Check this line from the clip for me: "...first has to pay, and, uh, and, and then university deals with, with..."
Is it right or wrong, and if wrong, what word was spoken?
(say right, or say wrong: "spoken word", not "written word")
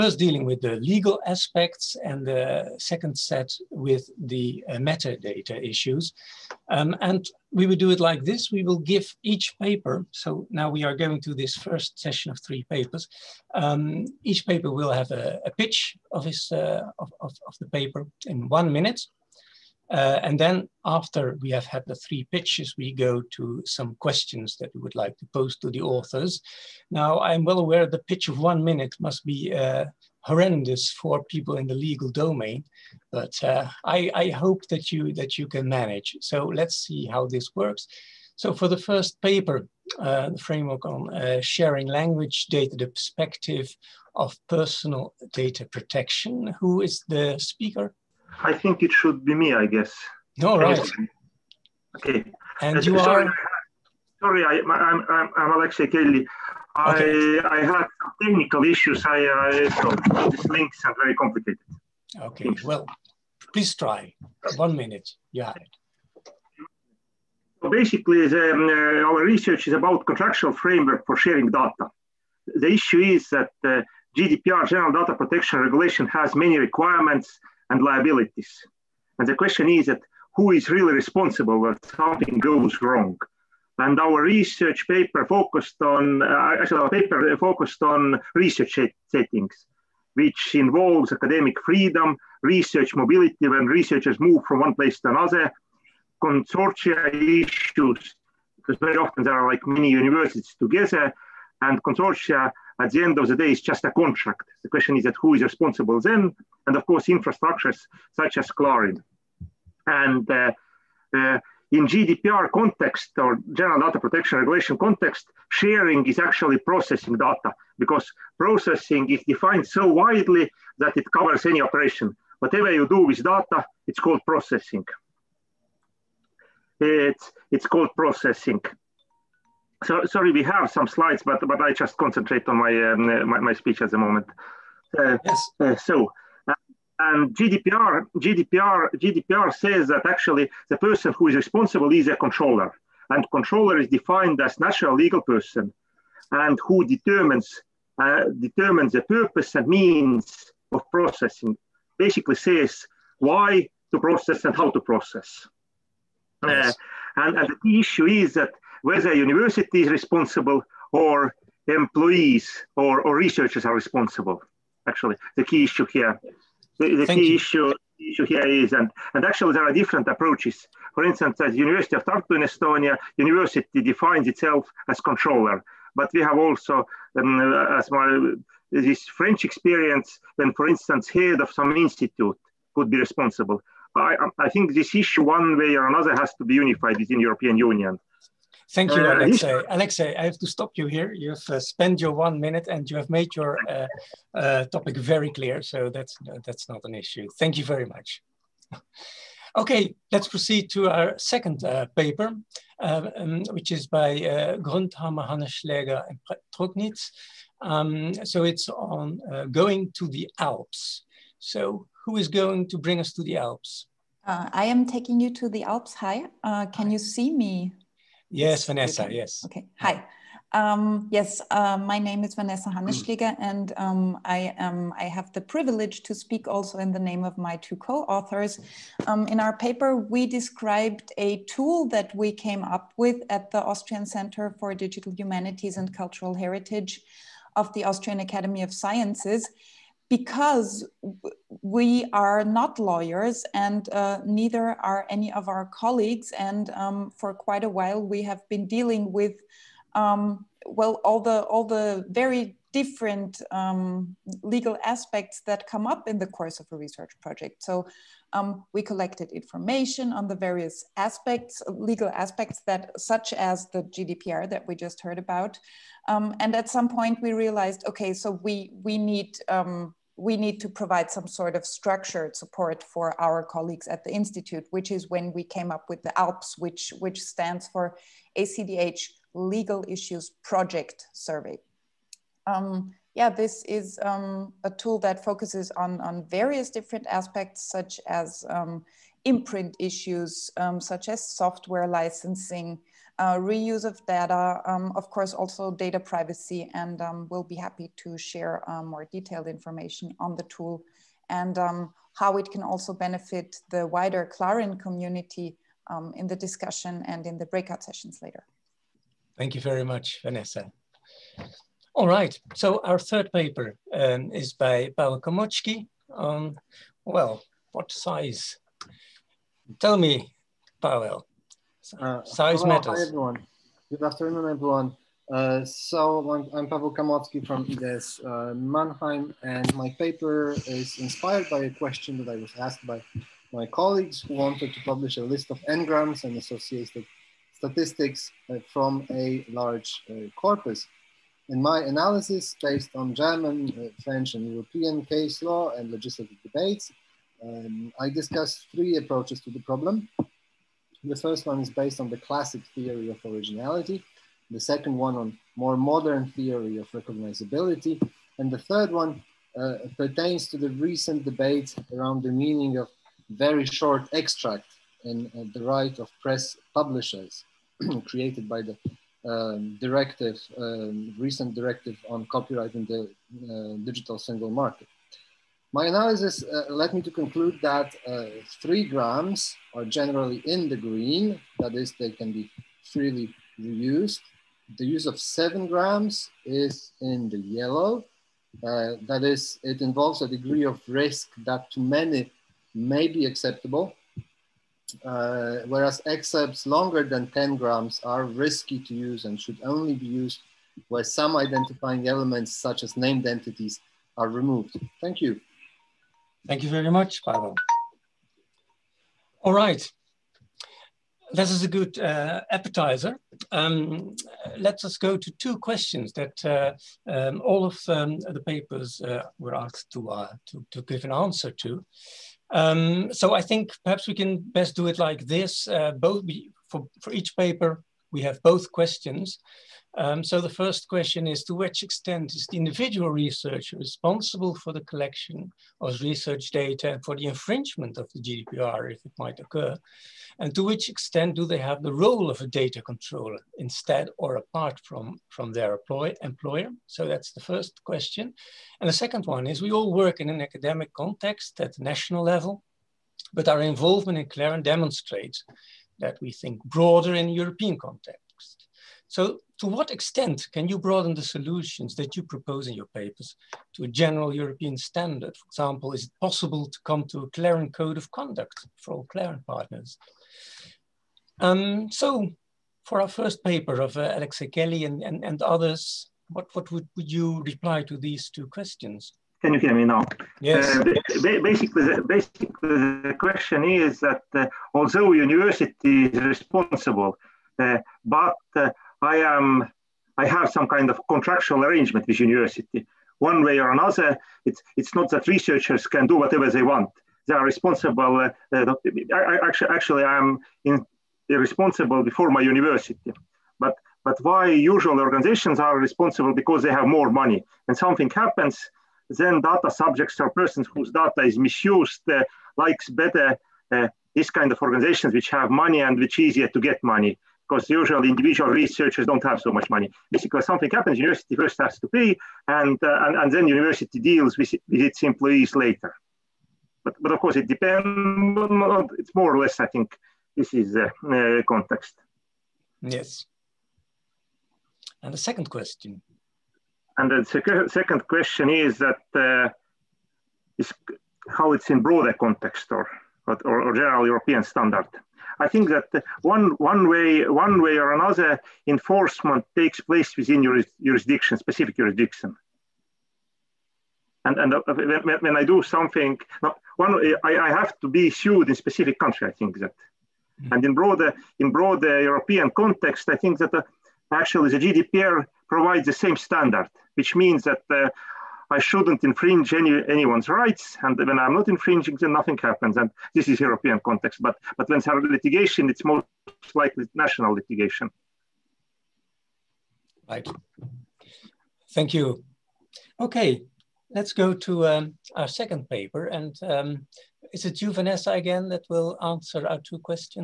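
right.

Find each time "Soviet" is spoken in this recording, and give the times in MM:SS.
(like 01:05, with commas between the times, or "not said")
not said.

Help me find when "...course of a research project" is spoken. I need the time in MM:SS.
04:16.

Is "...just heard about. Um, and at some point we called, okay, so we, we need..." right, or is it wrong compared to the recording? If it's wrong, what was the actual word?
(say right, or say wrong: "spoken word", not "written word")
wrong: "realized", not "called".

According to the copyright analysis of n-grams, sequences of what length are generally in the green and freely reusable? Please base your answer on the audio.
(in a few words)
3-grams.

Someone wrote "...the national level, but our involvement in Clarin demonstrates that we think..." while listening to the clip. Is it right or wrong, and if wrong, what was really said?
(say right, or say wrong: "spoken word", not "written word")
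right.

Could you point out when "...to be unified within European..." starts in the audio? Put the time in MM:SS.
03:06.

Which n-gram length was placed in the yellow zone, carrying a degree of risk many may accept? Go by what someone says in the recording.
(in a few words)
7-grams.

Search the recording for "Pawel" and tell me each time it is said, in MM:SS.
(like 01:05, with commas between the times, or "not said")
05:14, 05:20, 05:26, 06:47.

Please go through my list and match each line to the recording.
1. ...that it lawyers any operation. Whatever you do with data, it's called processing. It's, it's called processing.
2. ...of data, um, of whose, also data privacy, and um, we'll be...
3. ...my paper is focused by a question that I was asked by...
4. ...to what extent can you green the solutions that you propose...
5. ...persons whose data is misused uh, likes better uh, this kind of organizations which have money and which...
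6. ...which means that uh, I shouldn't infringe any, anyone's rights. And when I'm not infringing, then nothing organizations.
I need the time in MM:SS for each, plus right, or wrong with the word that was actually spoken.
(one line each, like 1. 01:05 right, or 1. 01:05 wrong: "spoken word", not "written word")
1. 02:00 wrong: "covers", not "lawyers"
2. 04:53 wrong: "course", not "whose"
3. 05:29 wrong: "inspired", not "focused"
4. 07:39 wrong: "broaden", not "green"
5. 08:30 right
6. 09:26 wrong: "happens", not "organizations".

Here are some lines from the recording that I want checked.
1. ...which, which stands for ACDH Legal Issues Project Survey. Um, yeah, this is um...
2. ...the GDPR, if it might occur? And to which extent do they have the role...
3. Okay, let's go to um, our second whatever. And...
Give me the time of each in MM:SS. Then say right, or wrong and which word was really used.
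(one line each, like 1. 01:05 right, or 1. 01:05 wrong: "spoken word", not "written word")
1. 04:36 right
2. 07:18 right
3. 09:42 wrong: "paper", not "whatever".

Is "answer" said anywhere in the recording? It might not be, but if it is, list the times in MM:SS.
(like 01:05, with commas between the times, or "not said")
07:01, 09:49.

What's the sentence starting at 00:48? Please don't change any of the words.
I think it should be me, I guess.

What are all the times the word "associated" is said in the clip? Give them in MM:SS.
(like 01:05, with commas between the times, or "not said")
05:36.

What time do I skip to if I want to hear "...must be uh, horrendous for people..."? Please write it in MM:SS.
00:28.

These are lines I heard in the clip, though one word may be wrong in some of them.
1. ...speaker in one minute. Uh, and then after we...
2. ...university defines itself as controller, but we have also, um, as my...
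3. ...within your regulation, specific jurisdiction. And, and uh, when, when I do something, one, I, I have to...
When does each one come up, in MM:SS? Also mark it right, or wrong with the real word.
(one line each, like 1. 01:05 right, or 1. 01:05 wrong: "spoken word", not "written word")
1. 00:17 wrong: "paper", not "speaker"
2. 02:53 right
3. 09:10 wrong: "jurisdiction", not "regulation".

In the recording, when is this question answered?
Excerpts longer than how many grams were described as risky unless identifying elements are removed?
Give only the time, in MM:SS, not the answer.
06:37.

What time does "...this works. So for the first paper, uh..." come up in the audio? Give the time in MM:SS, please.
00:37.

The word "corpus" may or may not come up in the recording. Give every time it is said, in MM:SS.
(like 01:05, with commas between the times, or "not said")
05:40.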